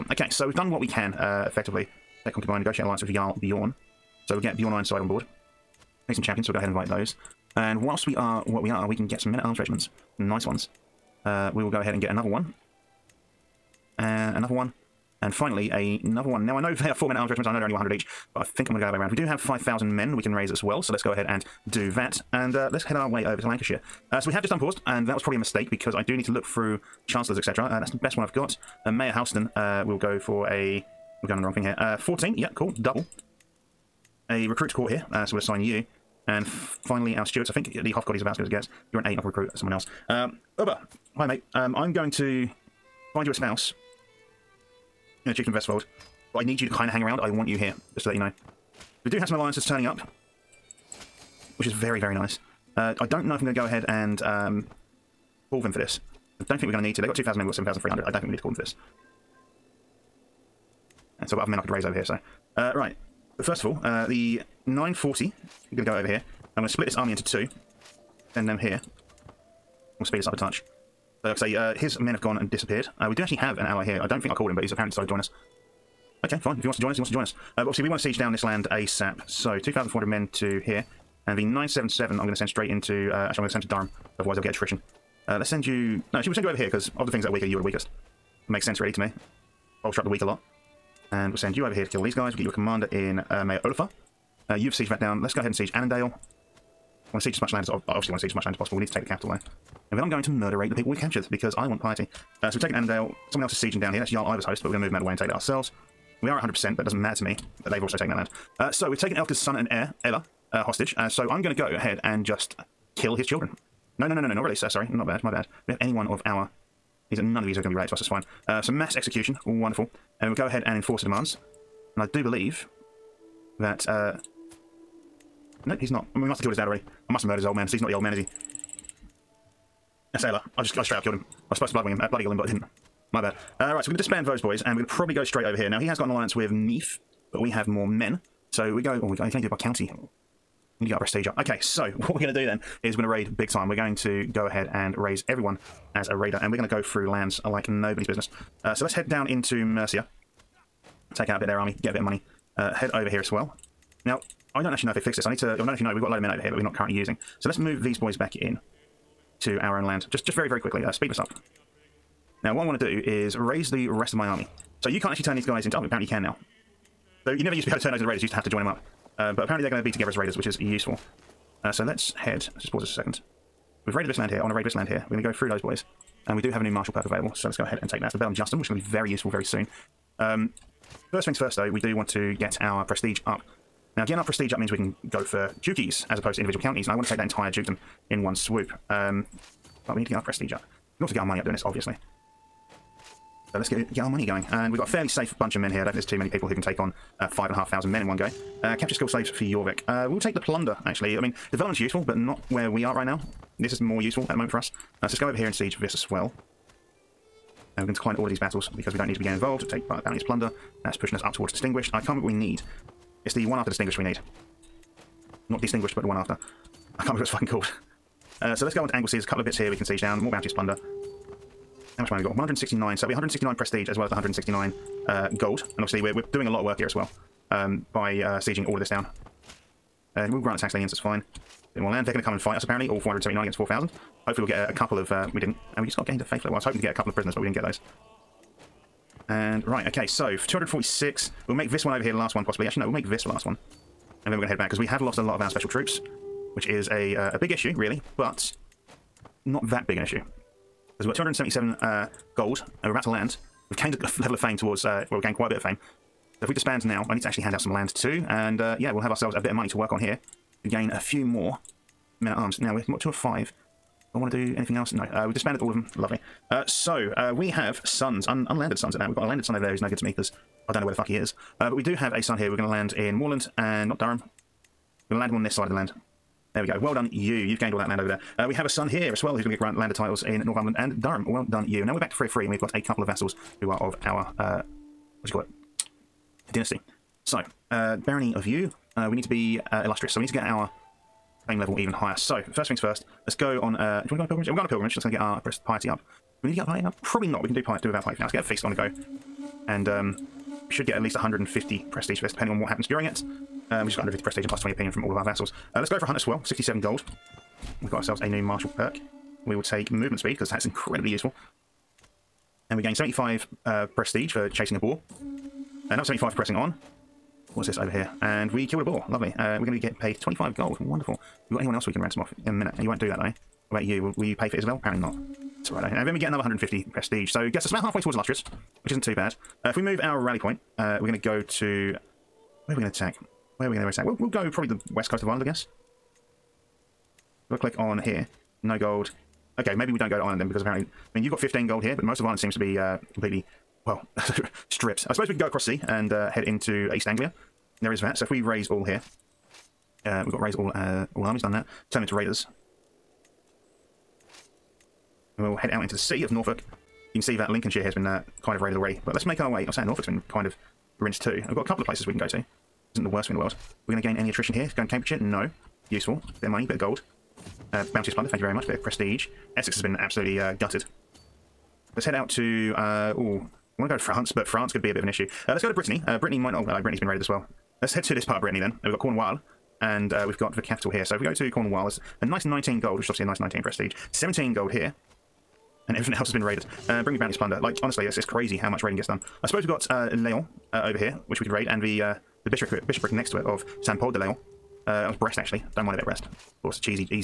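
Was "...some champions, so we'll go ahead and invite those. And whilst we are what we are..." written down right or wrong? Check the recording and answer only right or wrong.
right.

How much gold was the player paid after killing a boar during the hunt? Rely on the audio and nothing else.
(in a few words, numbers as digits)
25 gold.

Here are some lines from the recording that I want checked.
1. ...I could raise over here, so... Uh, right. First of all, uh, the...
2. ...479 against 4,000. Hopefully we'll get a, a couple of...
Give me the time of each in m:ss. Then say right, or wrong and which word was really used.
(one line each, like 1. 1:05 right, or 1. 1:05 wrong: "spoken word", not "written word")
1. 1:01 right
2. 3:52 right.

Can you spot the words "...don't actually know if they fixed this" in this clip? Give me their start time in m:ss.
2:34.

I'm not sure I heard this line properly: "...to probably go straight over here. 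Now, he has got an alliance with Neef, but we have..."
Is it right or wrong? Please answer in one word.
right.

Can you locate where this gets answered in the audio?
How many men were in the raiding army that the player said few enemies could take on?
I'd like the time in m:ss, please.
3:17.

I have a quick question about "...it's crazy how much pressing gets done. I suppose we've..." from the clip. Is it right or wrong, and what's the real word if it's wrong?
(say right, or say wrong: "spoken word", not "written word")
wrong: "raiding", not "pressing".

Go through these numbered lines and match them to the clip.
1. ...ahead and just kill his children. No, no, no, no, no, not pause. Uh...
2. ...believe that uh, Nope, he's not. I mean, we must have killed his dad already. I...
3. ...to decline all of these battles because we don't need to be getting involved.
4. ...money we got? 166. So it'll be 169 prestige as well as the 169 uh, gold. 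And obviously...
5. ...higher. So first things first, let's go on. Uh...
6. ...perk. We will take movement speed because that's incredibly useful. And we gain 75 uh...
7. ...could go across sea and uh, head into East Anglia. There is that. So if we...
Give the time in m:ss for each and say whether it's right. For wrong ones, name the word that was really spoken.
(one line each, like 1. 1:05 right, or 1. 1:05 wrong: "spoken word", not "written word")
1. 1:51 wrong: "release", not "pause"
2. 2:02 right
3. 3:27 right
4. 3:42 wrong: "169", not "166"
5. 4:51 right
6. 5:08 right
7. 5:45 right.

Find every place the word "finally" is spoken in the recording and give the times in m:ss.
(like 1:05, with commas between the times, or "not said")
0:15, 0:36.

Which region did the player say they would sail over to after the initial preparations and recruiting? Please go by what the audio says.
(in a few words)
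Lancashire.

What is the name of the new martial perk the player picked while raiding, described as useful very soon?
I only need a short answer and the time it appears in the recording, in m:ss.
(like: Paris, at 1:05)
Bellum Justum, at 2:58.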